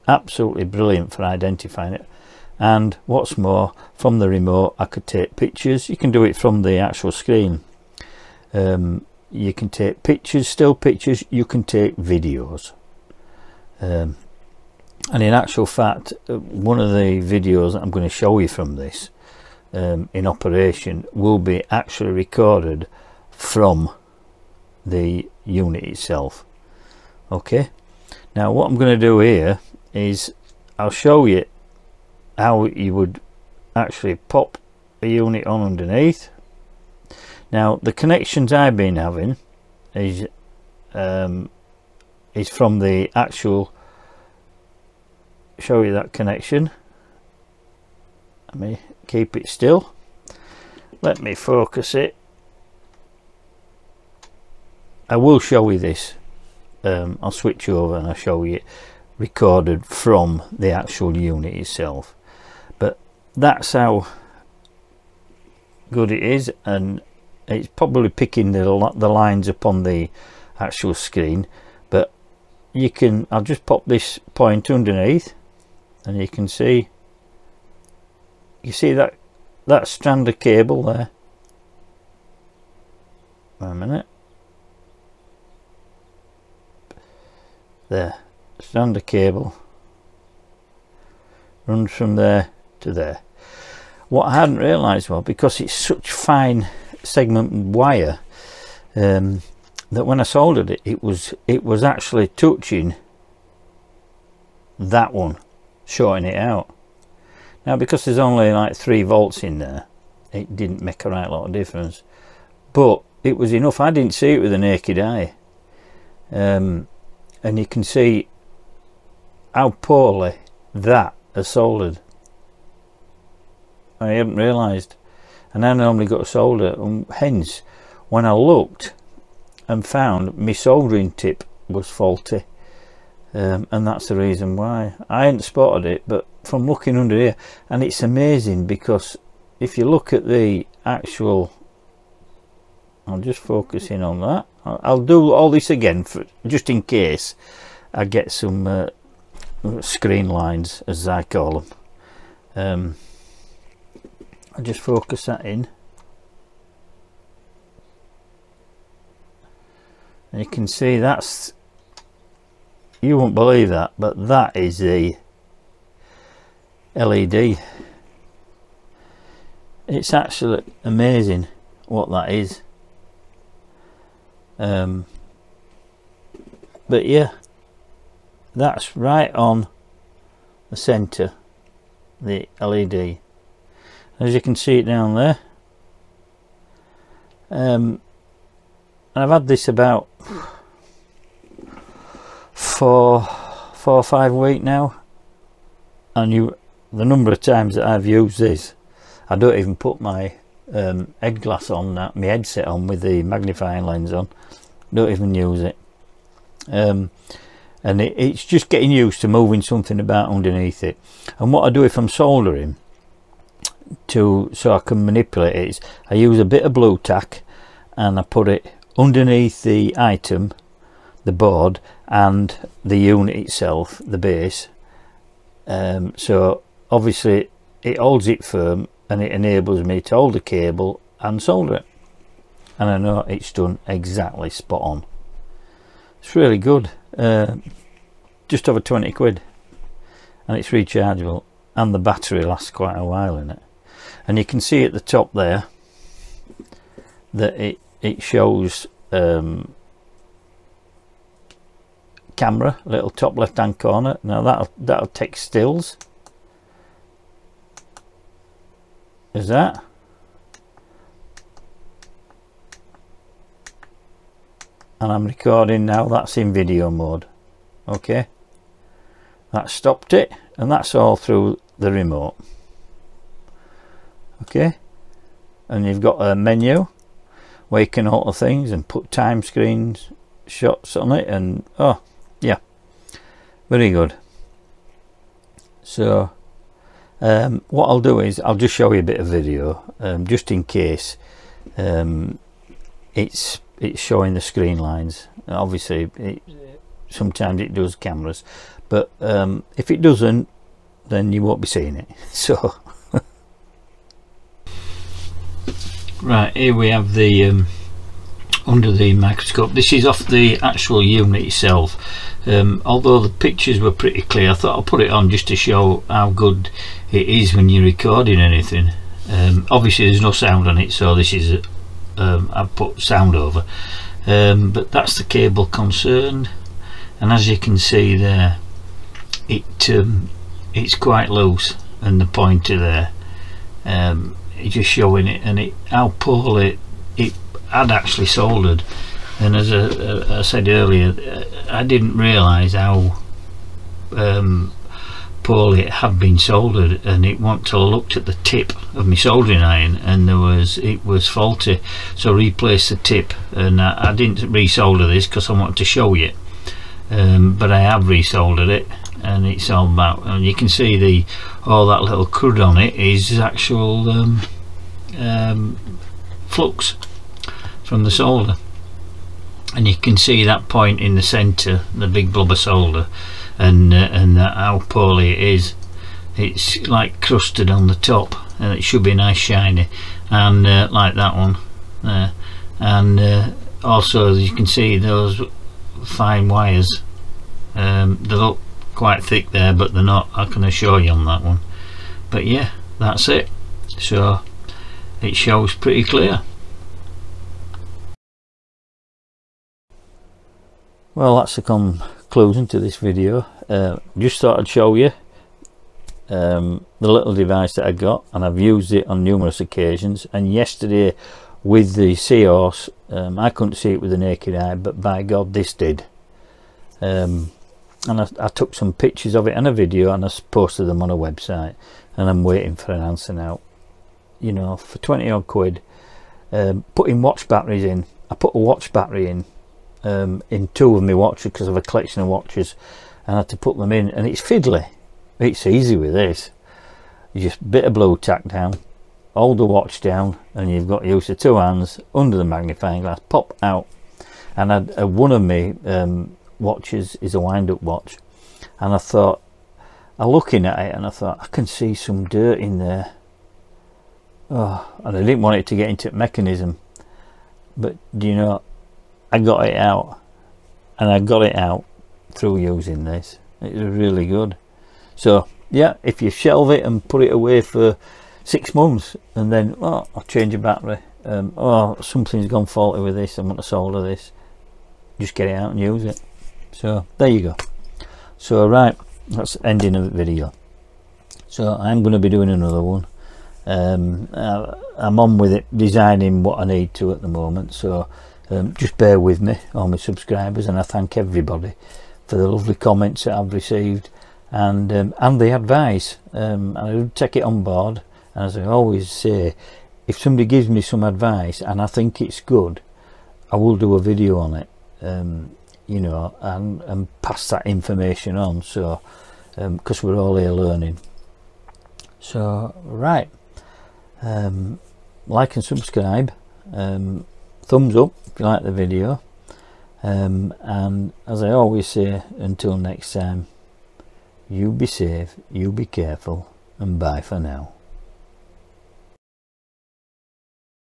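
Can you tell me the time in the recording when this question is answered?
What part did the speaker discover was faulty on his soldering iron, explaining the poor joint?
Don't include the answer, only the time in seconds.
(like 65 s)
130 s.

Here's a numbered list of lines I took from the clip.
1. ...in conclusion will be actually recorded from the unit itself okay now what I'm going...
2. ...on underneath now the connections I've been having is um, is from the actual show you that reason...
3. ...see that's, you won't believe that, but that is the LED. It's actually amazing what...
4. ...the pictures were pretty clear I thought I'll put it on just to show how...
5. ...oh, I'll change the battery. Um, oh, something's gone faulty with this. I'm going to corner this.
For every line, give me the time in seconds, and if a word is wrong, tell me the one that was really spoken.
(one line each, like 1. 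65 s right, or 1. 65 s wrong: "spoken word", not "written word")
1. 20 s wrong: "operation", not "conclusion"
2. 35 s wrong: "connection", not "reason"
3. 160 s right
4. 313 s right
5. 469 s wrong: "solder", not "corner".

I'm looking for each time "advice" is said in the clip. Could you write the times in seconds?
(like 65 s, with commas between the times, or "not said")
495 s, 501 s.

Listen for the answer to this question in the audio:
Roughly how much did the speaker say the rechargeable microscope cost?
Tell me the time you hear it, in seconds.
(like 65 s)
238 s.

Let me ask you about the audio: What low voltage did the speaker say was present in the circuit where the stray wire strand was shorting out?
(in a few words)
3 volts.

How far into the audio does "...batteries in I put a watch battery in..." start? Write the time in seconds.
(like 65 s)
427 s.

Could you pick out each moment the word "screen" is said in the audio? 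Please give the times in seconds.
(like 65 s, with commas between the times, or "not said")
7 s, 70 s, 149 s, 279 s, 294 s.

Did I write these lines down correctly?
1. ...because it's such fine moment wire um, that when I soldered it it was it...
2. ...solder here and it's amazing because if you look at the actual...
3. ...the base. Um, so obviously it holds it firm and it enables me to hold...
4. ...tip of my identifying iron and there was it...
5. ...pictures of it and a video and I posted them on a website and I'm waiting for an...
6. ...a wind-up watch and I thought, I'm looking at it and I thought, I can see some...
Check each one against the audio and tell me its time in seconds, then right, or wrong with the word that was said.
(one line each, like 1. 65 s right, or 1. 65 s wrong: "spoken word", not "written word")
1. 95 s wrong: "segment", not "moment"
2. 136 s wrong: "under", not "solder"
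3. 224 s right
4. 348 s wrong: "soldering", not "identifying"
5. 418 s right
6. 447 s right.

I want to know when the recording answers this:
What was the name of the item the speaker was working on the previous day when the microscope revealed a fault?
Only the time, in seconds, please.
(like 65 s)
412 s.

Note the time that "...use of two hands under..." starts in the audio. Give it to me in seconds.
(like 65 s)
441 s.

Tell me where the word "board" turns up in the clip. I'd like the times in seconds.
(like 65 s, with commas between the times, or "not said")
221 s, 497 s.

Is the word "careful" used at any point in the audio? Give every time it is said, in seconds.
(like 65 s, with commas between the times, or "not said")
525 s.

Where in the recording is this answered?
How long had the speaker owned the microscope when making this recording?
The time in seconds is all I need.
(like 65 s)
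193 s.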